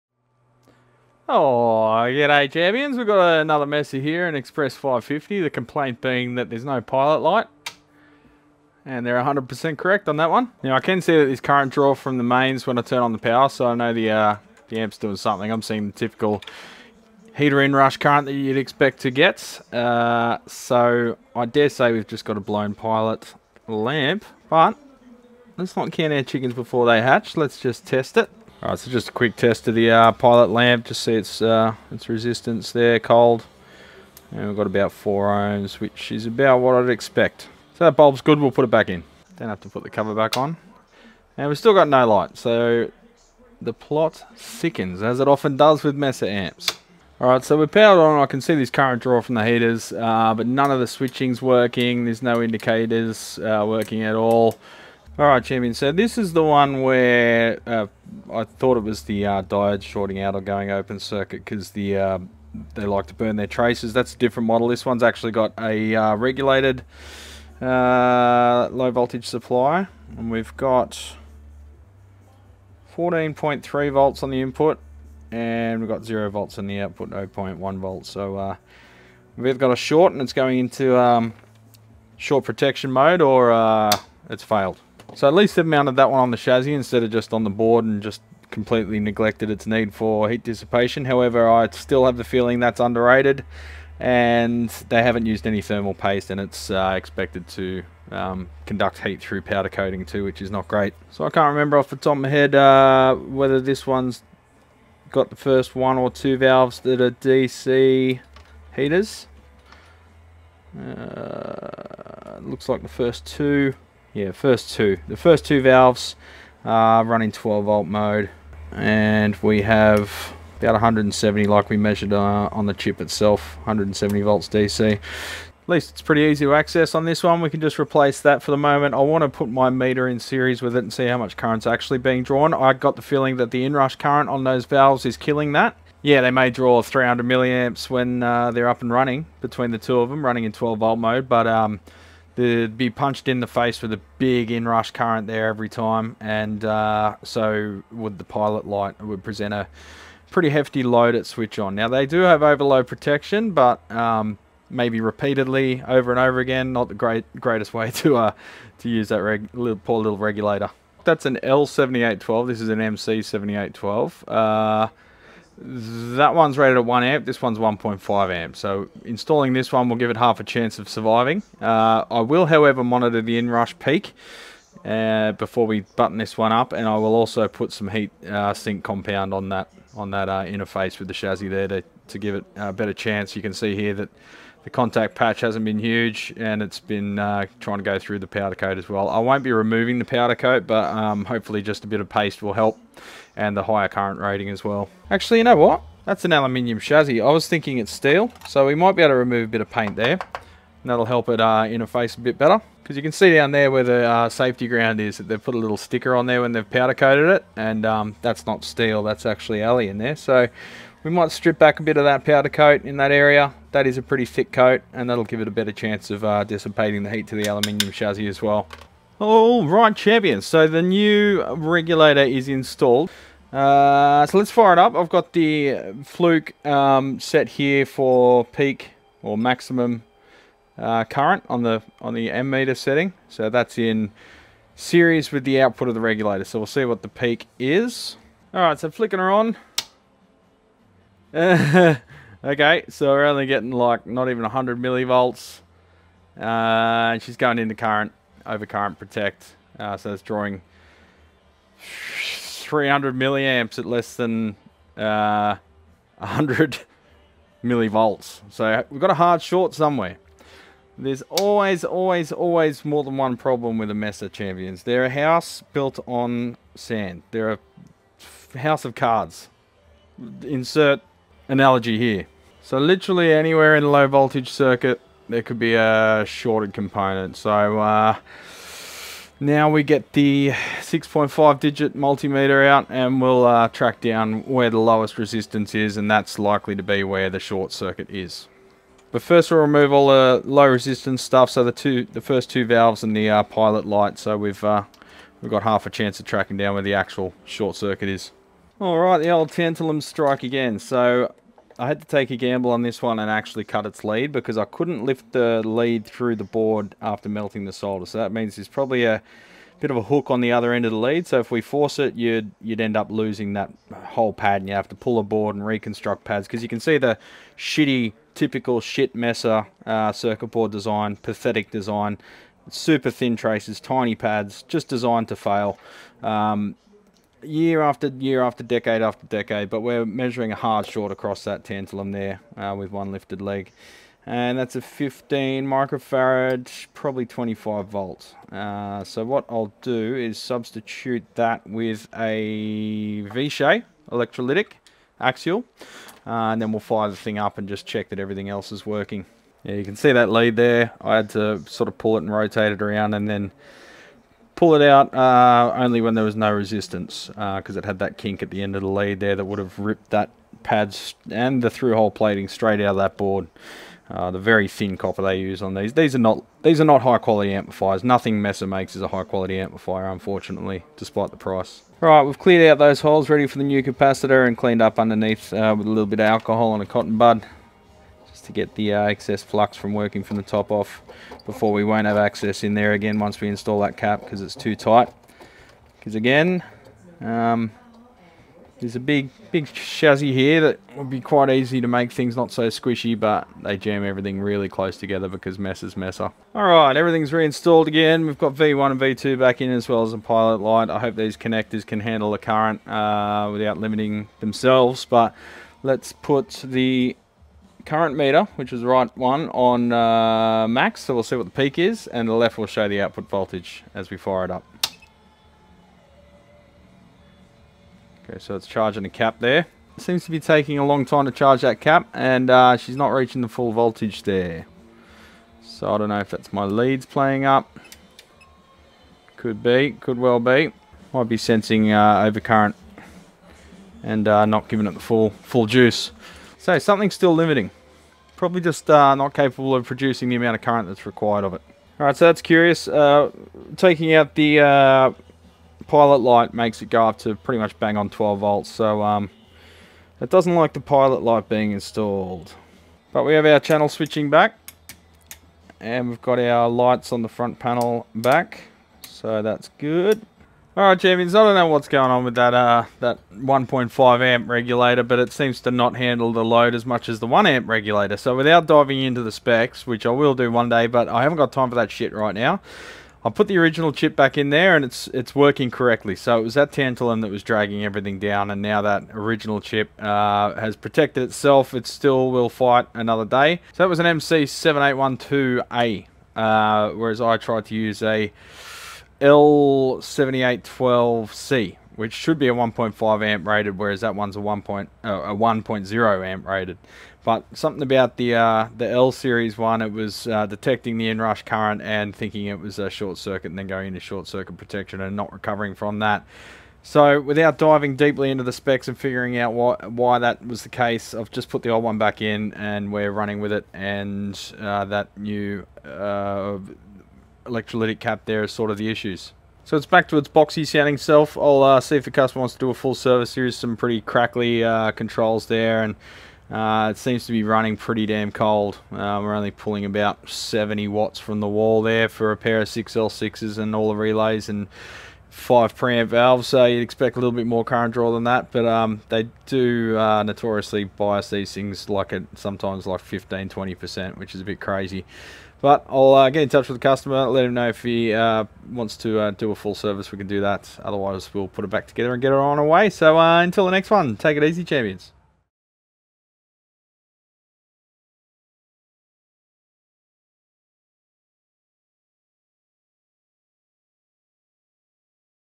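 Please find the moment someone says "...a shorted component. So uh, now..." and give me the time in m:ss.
4:35.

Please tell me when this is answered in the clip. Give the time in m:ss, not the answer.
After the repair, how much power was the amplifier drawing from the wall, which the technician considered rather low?
8:50.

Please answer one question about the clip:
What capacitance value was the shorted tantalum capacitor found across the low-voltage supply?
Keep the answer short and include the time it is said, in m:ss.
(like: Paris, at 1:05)
15 microfarads, at 5:34.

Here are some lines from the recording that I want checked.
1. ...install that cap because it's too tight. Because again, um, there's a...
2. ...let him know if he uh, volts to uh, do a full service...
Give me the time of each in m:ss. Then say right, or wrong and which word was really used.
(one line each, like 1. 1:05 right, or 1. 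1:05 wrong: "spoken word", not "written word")
1. 6:23 right
2. 9:07 wrong: "wants", not "volts".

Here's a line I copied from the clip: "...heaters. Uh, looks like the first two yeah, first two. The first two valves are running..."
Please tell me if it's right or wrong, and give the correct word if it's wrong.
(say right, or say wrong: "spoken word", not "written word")
right.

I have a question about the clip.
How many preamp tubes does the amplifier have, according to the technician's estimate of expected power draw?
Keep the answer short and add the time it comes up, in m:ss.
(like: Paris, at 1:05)
5, at 8:55.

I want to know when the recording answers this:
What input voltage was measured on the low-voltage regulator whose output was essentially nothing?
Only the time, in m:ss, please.
1:12.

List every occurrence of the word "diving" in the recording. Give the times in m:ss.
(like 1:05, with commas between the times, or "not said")
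7:48, 8:27.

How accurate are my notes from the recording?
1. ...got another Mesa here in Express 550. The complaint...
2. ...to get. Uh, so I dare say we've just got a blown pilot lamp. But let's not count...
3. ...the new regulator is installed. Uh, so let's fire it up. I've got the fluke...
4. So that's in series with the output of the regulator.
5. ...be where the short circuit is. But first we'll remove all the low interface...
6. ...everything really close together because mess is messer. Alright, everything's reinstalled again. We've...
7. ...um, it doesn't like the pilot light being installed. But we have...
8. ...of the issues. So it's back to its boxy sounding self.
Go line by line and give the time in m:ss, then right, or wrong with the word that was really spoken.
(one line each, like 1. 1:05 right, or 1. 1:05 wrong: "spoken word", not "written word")
1. 0:03 right
2. 0:19 right
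3. 3:40 right
4. 3:53 right
5. 4:46 wrong: "resistance", not "interface"
6. 6:34 right
7. 7:29 right
8. 8:38 right.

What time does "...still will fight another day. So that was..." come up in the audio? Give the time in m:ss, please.
8:01.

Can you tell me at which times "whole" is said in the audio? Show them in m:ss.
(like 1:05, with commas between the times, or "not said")
5:13.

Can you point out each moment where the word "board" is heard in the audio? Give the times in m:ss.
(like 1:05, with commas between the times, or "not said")
1:27, 5:06, 5:15, 5:20, 6:03.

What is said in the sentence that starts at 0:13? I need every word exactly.
So I know the, uh, the amp's doing something.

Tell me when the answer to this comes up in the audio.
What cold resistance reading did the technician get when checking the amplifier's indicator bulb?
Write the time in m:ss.
0:34.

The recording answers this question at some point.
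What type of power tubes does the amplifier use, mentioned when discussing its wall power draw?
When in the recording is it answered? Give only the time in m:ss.
8:52.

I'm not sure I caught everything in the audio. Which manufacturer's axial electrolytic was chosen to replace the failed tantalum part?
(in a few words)
Vishay.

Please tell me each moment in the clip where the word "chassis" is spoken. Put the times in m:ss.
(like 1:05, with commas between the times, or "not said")
1:26, 3:01, 3:16, 3:37, 6:29.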